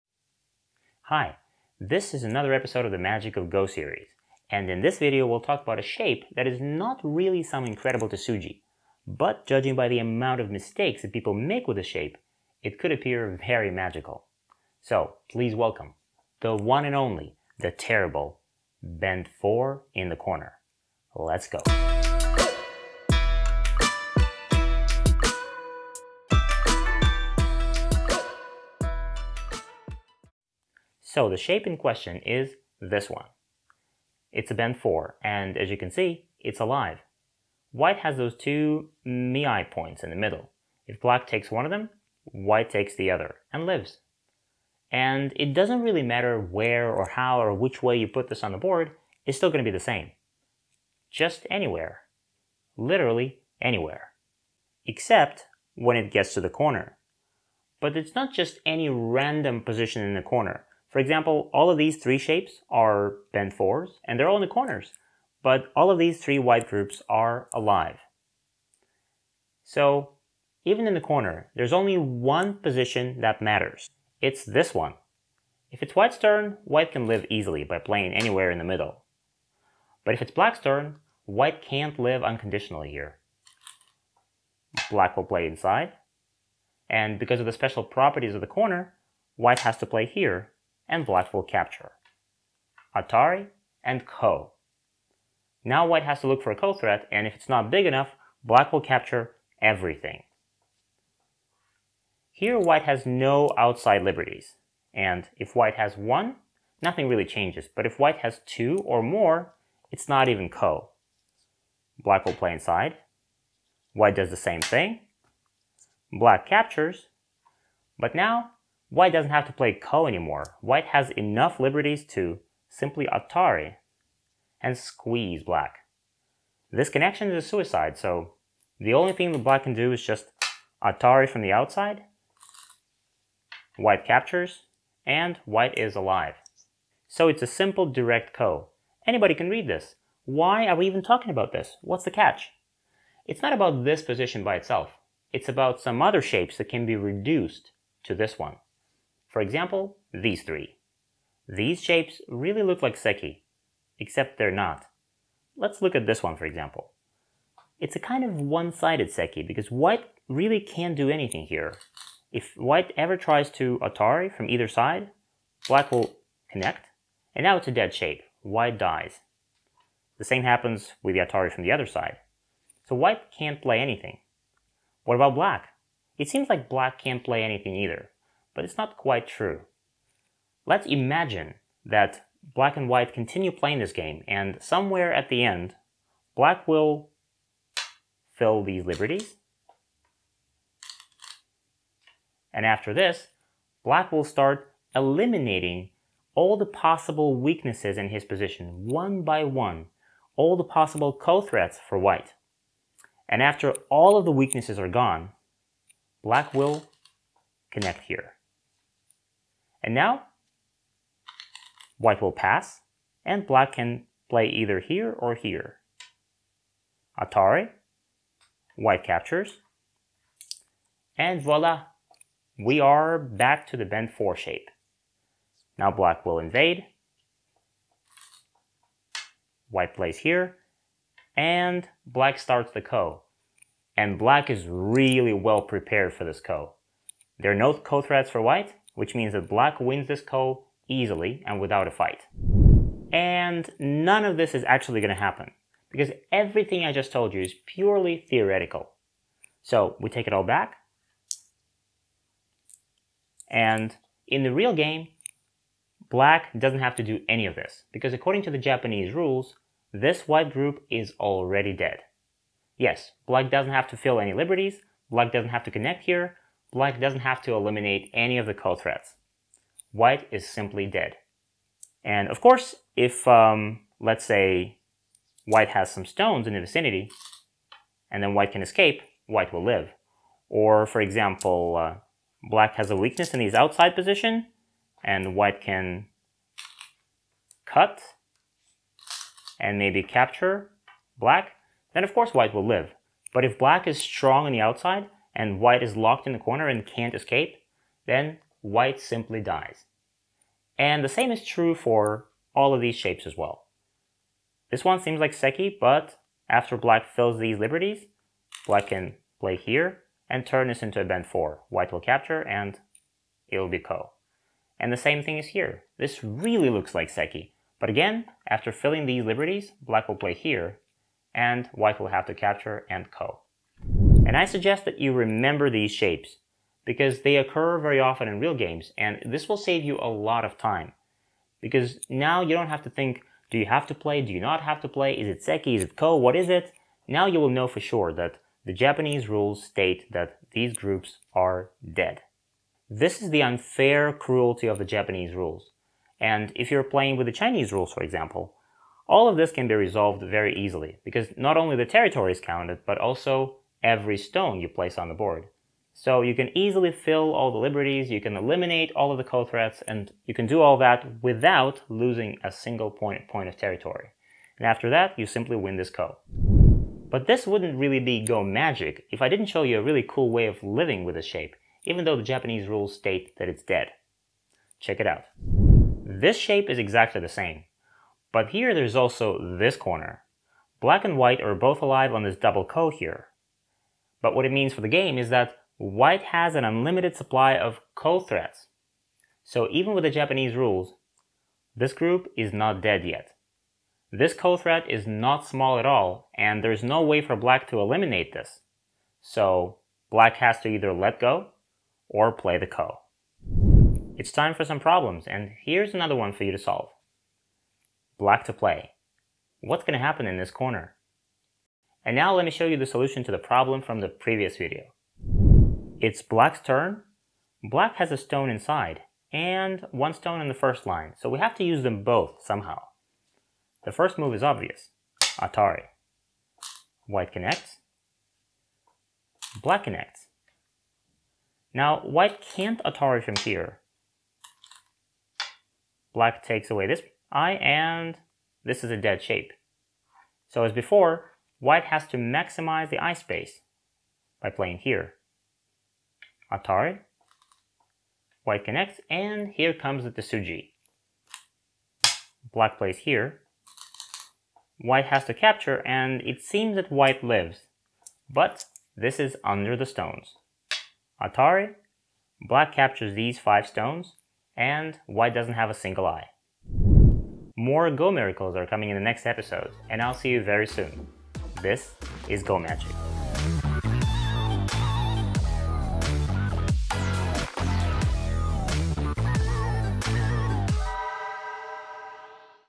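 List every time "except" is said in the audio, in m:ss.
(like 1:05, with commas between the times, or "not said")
0:54, 2:33.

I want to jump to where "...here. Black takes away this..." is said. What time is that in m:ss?
7:13.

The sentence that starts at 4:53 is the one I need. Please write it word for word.
But if black is strong on the outside, and white is locked in the corner and can't escape, then white simply dies.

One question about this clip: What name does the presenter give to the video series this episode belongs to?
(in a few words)
Magic of Go.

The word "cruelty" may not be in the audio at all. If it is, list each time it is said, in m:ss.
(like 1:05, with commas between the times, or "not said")
5:44.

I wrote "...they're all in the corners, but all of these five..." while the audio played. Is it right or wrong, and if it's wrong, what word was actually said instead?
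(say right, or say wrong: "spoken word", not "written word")
wrong: "three", not "five".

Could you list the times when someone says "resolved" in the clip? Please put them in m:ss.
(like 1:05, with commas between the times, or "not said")
5:49.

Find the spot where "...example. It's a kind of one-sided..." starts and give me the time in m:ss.
2:36.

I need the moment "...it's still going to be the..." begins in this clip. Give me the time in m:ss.
0:49.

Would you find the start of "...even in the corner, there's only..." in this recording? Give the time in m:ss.
1:10.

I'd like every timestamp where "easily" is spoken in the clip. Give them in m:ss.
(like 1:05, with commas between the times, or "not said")
1:17, 4:00, 5:50, 5:56.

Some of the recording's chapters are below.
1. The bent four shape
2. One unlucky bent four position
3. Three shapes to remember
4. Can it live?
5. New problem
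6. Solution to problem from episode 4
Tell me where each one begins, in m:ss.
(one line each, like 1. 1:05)
1. 0:31
2. 1:09
3. 2:23
4. 6:07
5. 6:43
6. 6:55.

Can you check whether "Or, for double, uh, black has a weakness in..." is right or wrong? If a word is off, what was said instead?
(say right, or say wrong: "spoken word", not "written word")
wrong: "example", not "double".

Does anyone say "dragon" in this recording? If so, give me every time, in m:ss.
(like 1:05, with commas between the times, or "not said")
not said.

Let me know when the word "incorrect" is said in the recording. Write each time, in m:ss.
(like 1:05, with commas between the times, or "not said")
not said.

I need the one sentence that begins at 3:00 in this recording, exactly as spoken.
Let's imagine that black and white continue playing this game, and somewhere at the end, black will fill these liberties.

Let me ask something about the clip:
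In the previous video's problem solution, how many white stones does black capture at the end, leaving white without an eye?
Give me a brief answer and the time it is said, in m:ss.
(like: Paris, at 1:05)
5, at 7:43.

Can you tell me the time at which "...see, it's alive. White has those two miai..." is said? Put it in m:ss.
0:35.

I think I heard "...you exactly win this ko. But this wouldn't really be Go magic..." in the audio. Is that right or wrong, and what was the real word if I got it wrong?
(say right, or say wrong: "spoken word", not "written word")
wrong: "simply", not "exactly".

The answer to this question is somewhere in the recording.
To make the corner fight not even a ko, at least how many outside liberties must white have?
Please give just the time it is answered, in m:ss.
1:48.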